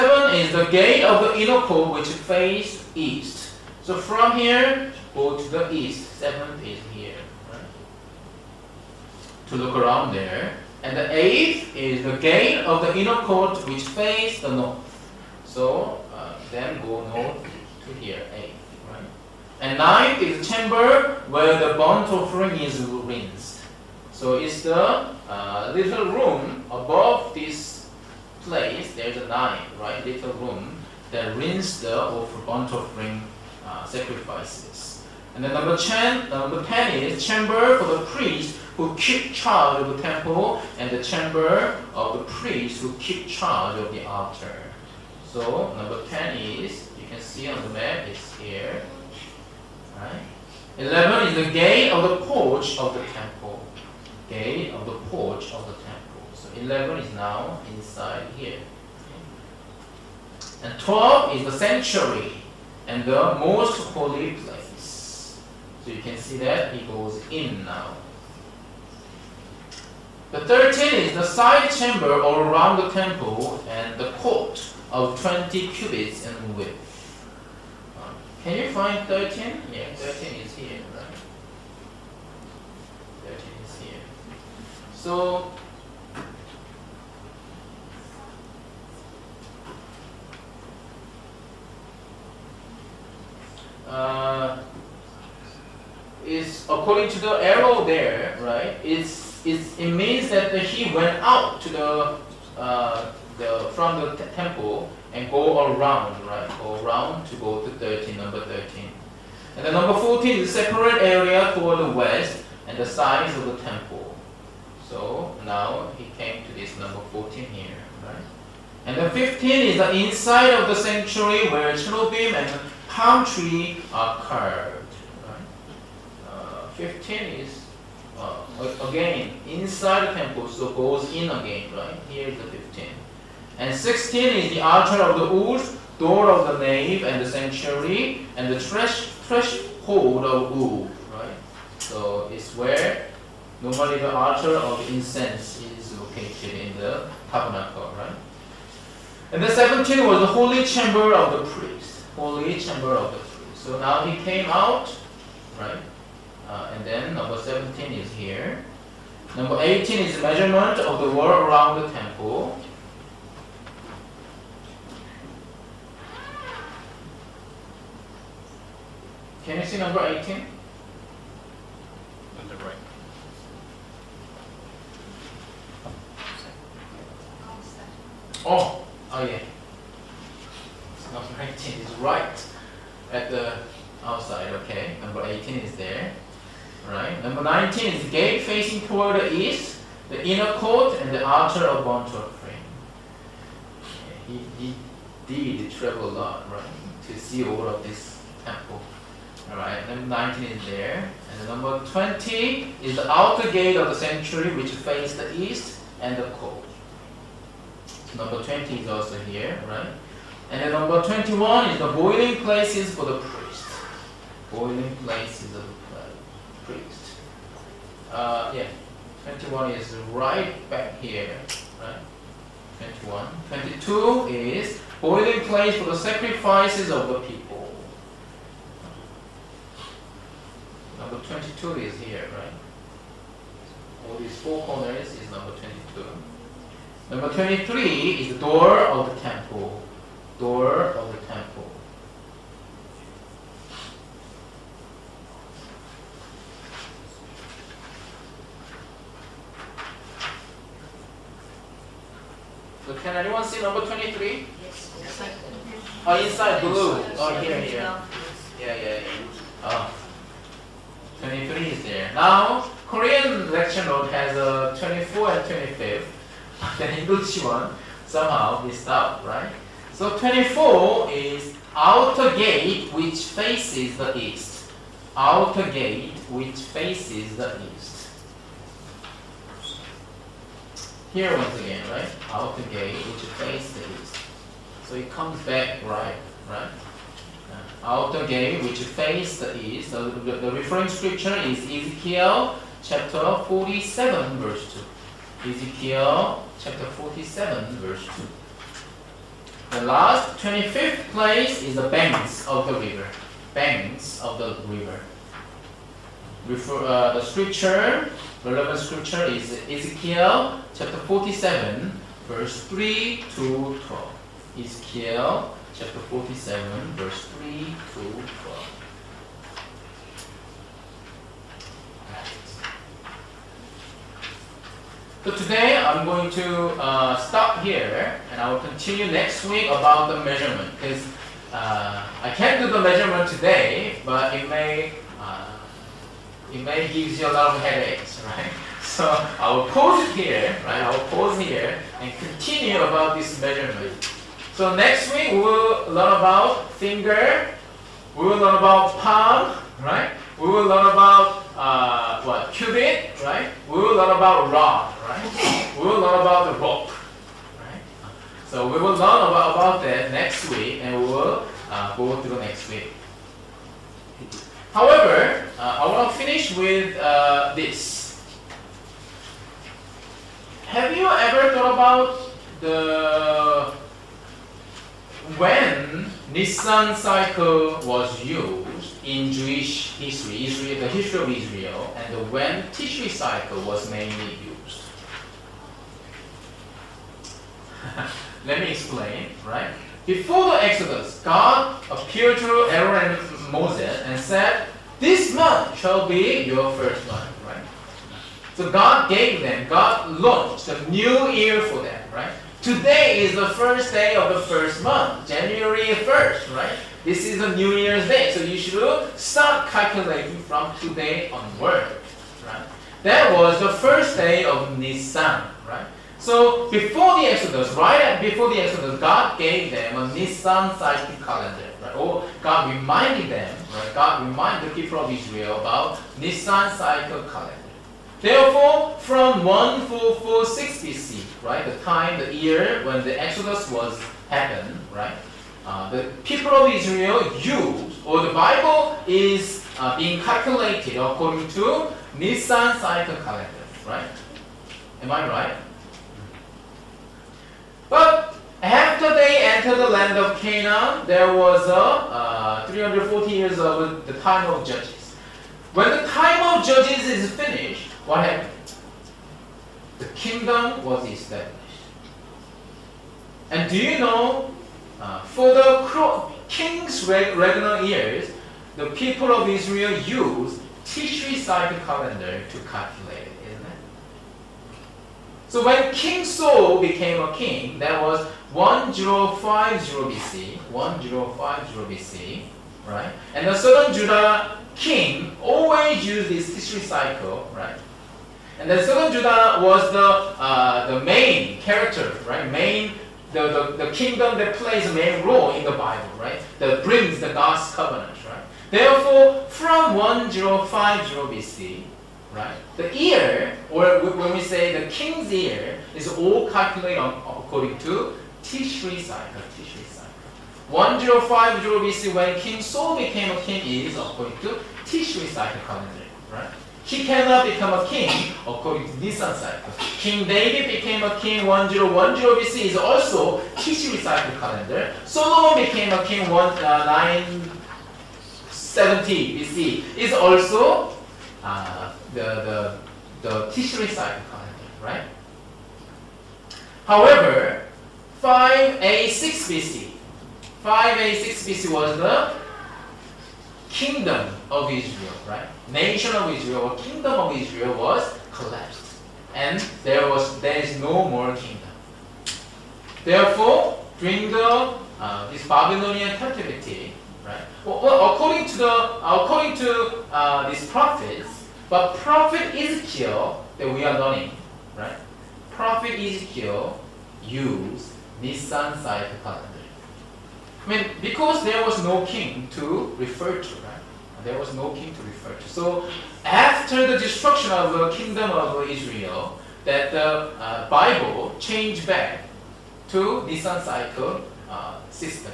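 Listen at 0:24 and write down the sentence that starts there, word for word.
So it's the uh, little room above this place, there's a 9, right?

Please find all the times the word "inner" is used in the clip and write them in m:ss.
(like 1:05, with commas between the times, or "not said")
0:01, 0:12, 3:10.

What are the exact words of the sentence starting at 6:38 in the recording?
So God gave them, God launched a new year for them, right?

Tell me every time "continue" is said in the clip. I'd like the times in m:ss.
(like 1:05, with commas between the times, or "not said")
5:28, 5:42.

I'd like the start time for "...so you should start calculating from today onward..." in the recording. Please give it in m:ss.
6:48.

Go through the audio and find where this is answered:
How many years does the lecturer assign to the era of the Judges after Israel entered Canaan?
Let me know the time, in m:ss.
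7:32.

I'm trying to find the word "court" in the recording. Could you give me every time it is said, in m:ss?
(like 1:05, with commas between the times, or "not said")
0:01, 0:13, 1:14, 3:10.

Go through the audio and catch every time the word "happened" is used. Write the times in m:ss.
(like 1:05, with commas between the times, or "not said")
7:14, 7:38.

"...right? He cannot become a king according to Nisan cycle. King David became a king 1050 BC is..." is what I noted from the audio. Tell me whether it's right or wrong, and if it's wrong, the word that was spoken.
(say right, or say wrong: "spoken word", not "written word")
wrong: "1010", not "1050".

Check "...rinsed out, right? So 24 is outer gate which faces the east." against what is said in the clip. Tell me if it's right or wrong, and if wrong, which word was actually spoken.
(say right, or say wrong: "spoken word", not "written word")
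wrong: "missed", not "rinsed".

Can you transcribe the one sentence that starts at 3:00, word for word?
It's eighteen is right at the outside, okay.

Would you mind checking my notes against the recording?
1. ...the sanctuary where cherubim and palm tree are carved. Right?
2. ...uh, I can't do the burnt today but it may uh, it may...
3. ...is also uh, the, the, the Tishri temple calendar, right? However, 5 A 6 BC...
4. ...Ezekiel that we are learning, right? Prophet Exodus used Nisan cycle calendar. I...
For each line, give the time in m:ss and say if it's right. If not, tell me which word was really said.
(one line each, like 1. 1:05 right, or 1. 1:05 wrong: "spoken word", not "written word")
1. 2:00 right
2. 5:31 wrong: "measurement", not "burnt"
3. 8:49 wrong: "cycle", not "temple"
4. 9:22 wrong: "Ezekiel", not "Exodus".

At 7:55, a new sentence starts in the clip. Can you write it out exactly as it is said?
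So when King Saul became a king, that was 1050 BC, 1050 BC, right?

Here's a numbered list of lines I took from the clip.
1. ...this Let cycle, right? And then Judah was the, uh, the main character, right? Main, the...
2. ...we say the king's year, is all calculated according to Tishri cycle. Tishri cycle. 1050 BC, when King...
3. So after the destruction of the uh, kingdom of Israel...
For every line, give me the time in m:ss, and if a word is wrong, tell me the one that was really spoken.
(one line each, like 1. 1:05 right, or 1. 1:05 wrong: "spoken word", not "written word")
1. 8:06 wrong: "Tishri", not "Let"
2. 8:24 right
3. 9:35 right.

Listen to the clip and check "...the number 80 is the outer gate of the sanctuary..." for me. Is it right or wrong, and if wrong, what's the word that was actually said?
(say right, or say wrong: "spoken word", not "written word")
wrong: "20", not "80".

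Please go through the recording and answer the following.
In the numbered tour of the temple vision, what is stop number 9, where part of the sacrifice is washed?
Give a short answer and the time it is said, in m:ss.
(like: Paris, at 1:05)
Chamber where the burnt offering is rinsed, at 0:20.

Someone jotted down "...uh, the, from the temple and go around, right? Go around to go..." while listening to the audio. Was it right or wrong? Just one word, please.
right.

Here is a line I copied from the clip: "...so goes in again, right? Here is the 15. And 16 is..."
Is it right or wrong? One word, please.
right.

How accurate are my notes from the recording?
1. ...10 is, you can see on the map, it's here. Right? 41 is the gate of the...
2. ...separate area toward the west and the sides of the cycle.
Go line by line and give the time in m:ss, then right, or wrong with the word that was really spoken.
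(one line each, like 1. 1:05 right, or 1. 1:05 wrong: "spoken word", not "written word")
1. 0:46 wrong: "11", not "41"
2. 1:50 wrong: "temple", not "cycle".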